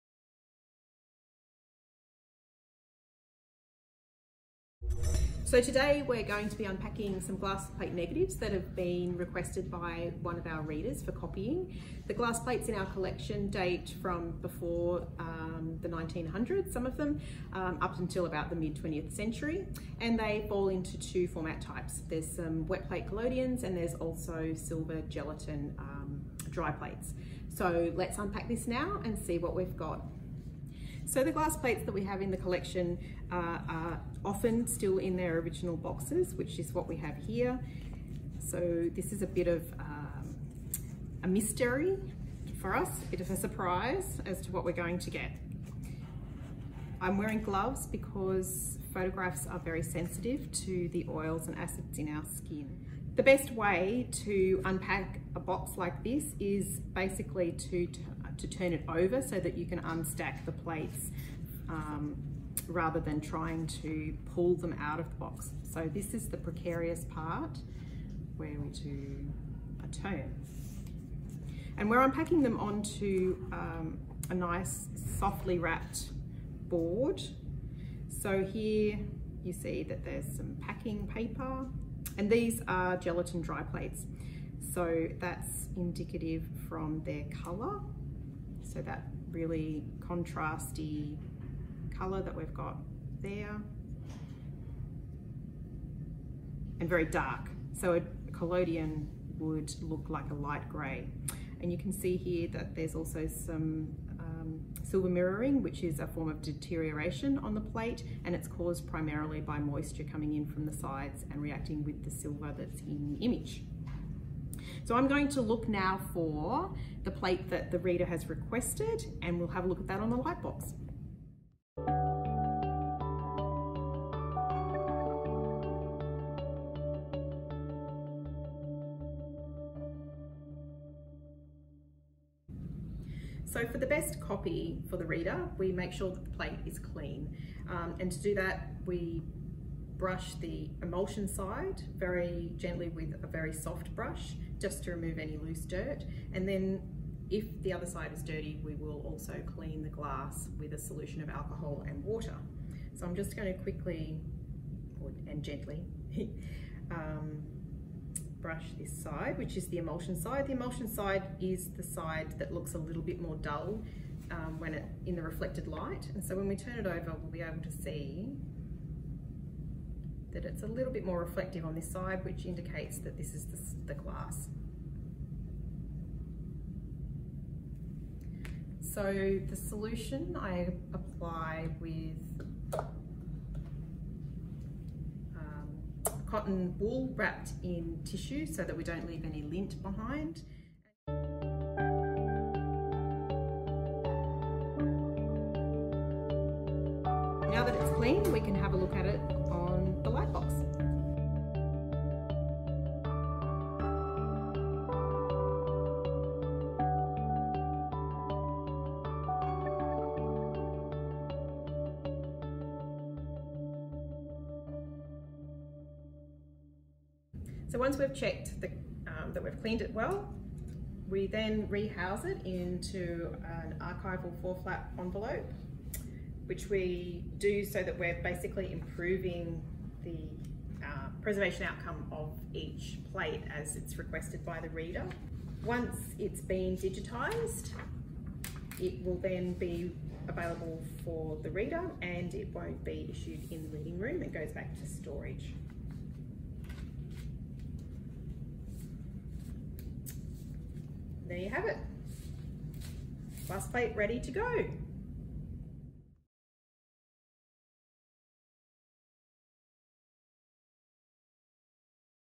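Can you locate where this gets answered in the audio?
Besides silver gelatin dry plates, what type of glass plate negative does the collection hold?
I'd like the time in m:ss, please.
0:22.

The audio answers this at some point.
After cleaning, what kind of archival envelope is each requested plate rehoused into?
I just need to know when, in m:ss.
3:44.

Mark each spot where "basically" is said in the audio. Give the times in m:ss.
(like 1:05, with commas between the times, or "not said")
0:56, 3:48.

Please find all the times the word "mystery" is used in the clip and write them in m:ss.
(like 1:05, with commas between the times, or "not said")
0:41.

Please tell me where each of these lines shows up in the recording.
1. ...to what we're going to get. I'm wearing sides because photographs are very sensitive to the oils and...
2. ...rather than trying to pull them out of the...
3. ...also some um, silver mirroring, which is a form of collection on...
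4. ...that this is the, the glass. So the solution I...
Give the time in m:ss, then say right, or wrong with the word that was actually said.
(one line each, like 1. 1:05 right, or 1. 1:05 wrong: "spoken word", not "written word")
1. 0:44 wrong: "gloves", not "sides"
2. 1:02 right
3. 1:42 wrong: "deterioration", not "collection"
4. 2:52 right.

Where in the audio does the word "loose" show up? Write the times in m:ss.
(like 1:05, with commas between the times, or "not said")
2:25.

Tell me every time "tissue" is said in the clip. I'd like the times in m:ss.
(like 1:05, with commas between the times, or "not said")
3:08.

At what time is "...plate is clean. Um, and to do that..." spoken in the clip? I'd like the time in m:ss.
2:16.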